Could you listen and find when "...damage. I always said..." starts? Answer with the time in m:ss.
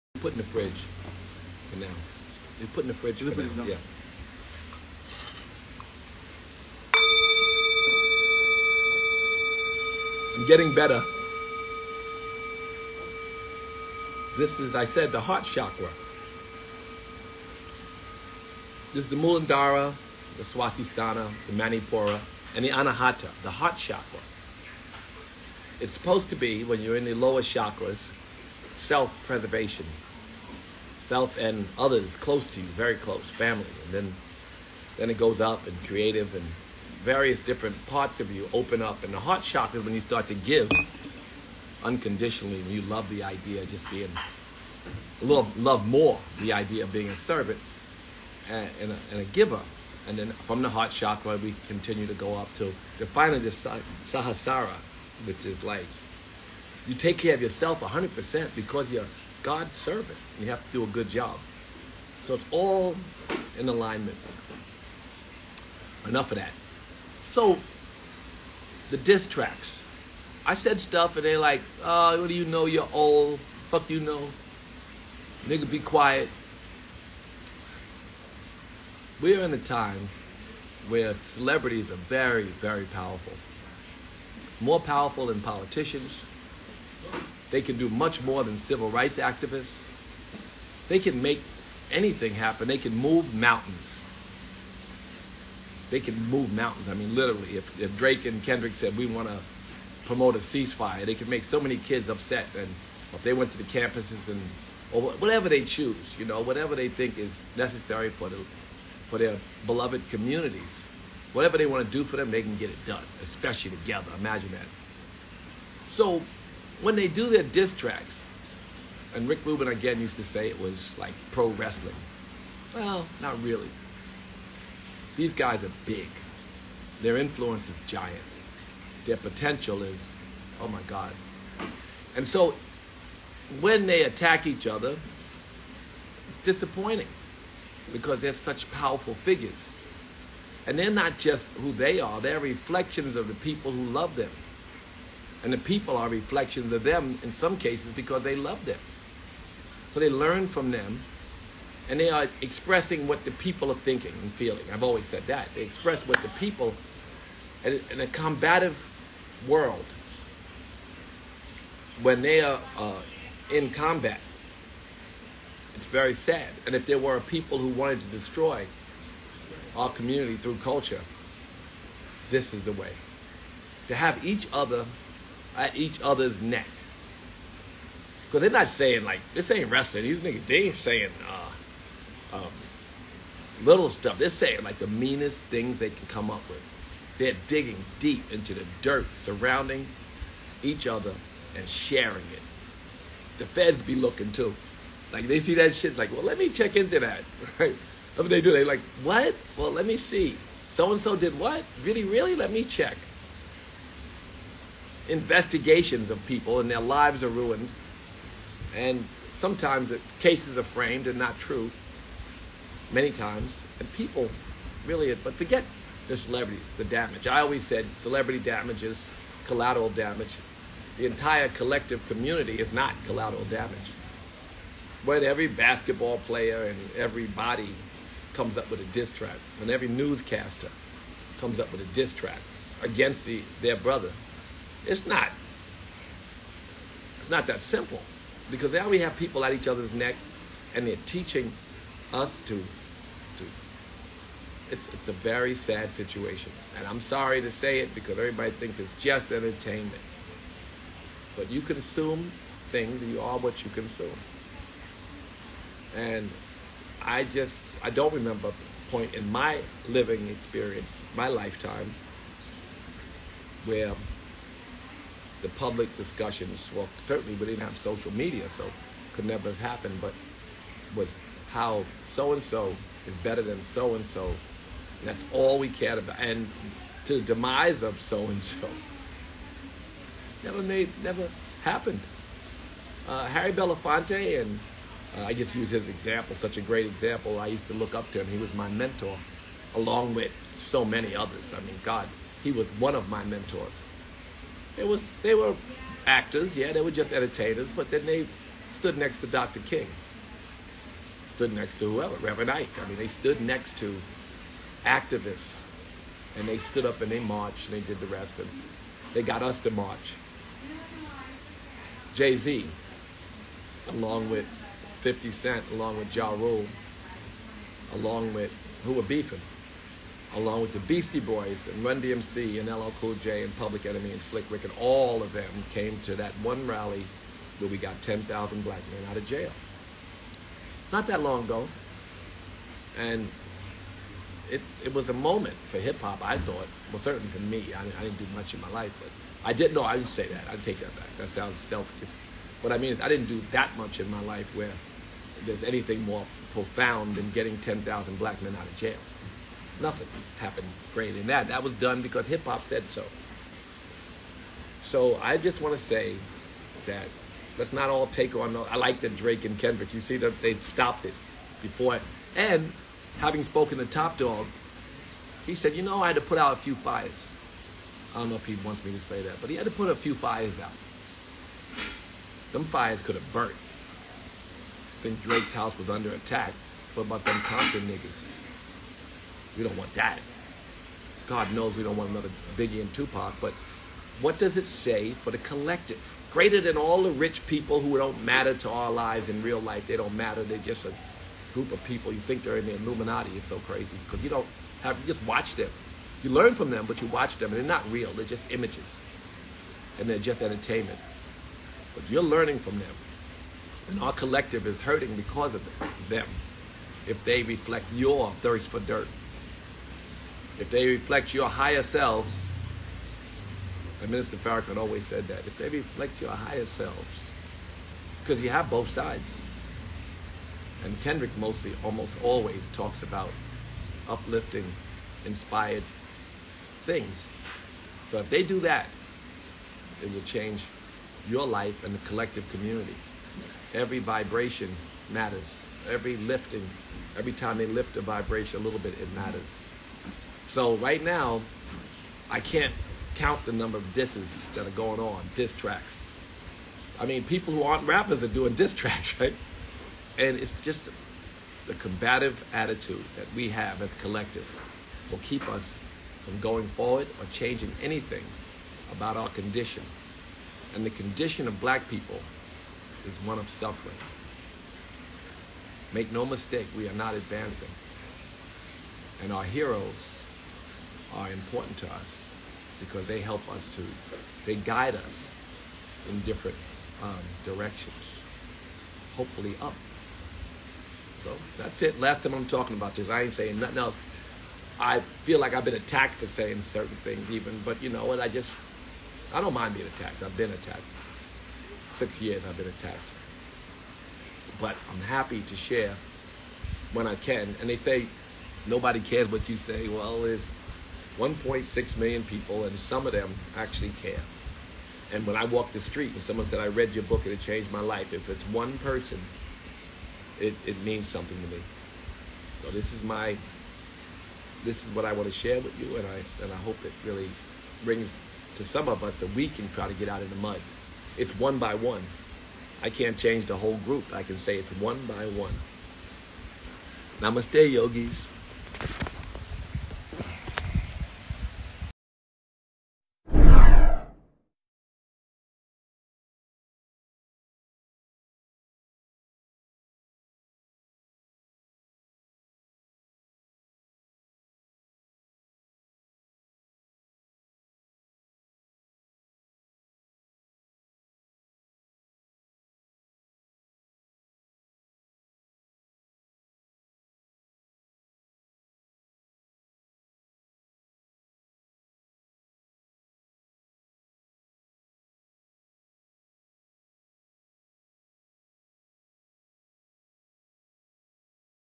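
3:36.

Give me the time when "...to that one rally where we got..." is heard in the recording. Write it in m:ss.
5:26.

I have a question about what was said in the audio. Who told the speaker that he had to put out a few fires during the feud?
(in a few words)
Top Dawg.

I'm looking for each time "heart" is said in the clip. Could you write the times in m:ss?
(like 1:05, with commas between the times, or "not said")
0:15, 0:23, 0:39, 0:50.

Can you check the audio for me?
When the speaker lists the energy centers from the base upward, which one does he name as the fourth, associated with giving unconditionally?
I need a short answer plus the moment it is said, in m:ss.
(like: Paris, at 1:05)
Anahata, at 0:22.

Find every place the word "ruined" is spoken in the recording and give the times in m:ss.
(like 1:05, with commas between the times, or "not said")
3:27.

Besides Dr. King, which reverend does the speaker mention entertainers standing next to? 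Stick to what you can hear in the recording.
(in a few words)
Reverend Ike.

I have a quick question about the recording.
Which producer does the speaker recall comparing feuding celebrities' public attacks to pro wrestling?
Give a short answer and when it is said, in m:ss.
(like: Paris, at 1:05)
Rick Rubin, at 1:59.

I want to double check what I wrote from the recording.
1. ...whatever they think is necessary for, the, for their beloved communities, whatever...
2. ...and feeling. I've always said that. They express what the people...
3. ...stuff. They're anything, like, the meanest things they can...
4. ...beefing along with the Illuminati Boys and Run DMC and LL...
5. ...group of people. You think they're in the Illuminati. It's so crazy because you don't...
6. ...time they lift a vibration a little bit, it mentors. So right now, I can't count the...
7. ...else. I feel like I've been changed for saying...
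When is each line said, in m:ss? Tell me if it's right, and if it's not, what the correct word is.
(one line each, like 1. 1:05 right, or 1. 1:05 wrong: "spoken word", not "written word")
1. 1:46 right
2. 2:34 right
3. 3:03 wrong: "saying", not "anything"
4. 5:19 wrong: "Beastie", not "Illuminati"
5. 6:31 right
6. 7:17 wrong: "matters", not "mentors"
7. 8:03 wrong: "attacked", not "changed".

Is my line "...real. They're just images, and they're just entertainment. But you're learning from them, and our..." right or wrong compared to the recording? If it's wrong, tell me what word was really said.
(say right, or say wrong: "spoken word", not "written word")
right.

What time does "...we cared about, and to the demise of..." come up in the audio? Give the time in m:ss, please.
4:35.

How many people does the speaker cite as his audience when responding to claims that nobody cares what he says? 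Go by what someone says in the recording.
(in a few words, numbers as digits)
1.6 million.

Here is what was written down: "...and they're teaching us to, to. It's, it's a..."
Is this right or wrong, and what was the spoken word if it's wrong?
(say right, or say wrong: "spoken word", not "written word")
right.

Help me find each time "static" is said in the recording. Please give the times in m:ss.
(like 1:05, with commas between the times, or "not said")
not said.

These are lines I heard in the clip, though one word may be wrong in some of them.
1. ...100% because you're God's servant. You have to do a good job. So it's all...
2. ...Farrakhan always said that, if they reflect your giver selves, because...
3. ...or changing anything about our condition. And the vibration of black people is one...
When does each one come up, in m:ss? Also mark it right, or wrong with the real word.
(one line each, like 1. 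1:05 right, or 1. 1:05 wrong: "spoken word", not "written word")
1. 0:57 right
2. 6:54 wrong: "higher", not "giver"
3. 7:37 wrong: "condition", not "vibration".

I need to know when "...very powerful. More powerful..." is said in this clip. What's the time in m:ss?
1:22.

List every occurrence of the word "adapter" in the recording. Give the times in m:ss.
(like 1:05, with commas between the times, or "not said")
not said.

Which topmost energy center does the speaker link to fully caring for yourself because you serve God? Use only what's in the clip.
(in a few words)
Sahasrara.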